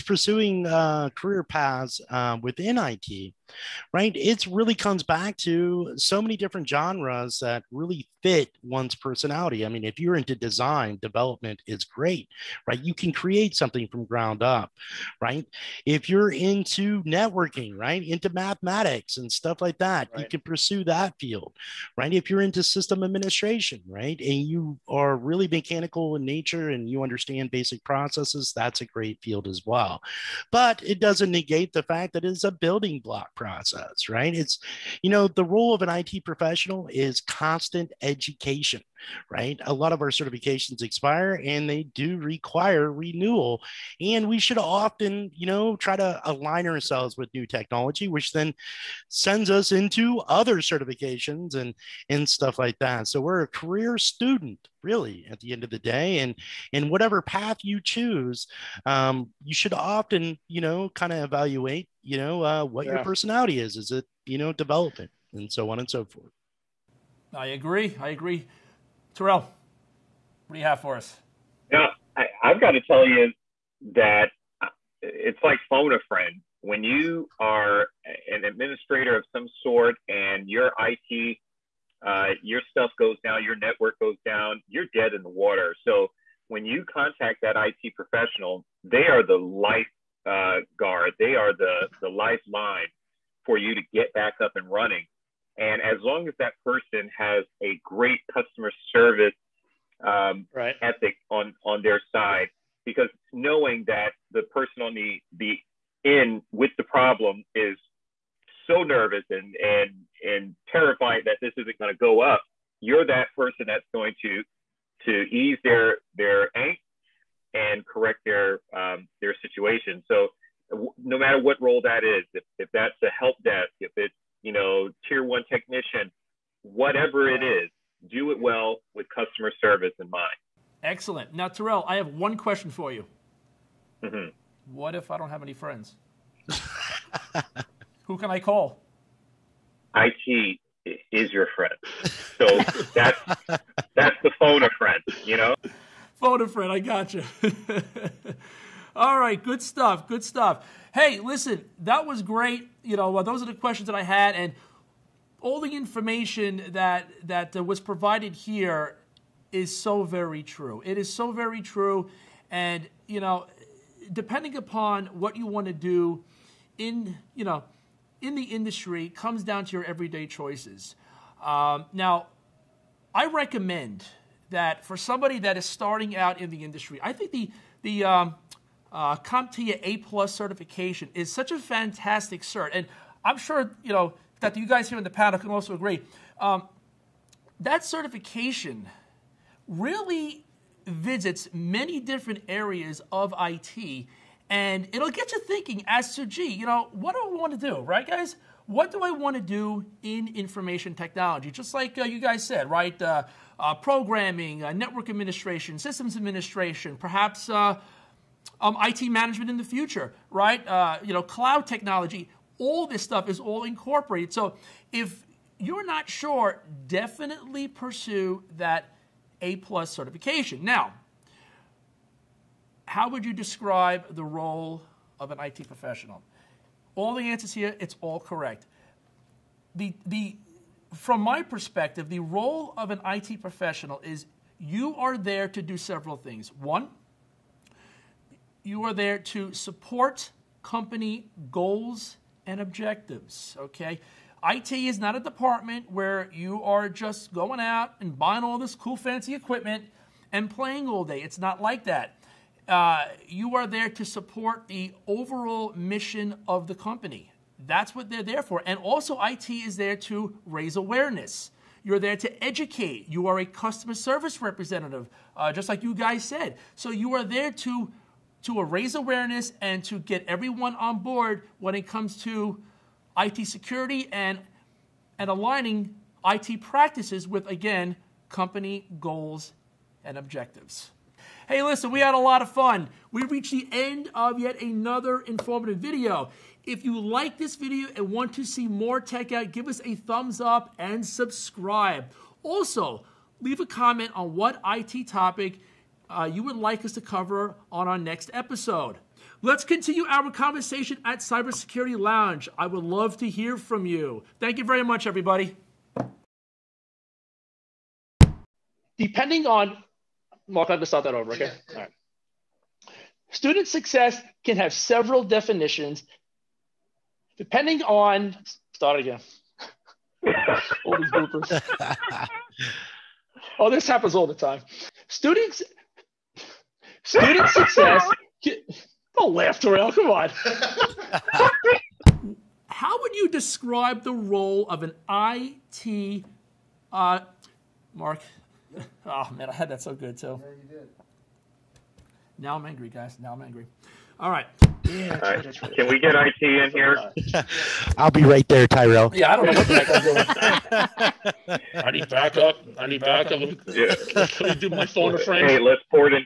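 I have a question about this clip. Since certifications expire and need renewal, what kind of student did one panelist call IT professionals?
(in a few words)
Career student.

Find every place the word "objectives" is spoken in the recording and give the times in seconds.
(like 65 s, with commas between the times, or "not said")
242 s, 280 s.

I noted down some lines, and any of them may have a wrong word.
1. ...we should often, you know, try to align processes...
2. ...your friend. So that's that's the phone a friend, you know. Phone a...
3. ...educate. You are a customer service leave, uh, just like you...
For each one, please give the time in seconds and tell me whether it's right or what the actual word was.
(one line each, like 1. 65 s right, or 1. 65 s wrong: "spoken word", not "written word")
1. 44 s wrong: "ourselves", not "processes"
2. 141 s right
3. 262 s wrong: "representative", not "leave".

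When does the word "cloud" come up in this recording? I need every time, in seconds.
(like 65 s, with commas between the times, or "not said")
211 s.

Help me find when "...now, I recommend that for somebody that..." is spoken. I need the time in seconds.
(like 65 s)
171 s.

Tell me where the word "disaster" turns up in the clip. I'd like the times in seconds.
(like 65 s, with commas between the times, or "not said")
not said.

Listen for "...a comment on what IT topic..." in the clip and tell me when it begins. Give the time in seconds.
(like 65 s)
293 s.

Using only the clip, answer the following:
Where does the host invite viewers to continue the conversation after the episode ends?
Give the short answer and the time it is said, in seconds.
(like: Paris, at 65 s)
Cybersecurity Lounge, at 301 s.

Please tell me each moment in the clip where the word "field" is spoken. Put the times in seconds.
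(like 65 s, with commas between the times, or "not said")
21 s, 29 s.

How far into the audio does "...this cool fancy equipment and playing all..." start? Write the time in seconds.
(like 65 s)
248 s.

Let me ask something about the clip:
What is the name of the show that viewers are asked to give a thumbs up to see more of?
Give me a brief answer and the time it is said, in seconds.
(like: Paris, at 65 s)
Tech Out, at 288 s.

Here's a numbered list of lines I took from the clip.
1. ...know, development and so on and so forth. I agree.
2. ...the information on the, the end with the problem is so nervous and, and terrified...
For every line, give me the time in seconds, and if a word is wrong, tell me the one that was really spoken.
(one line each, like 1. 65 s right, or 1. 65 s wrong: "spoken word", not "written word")
1. 64 s right
2. 104 s wrong: "person", not "information".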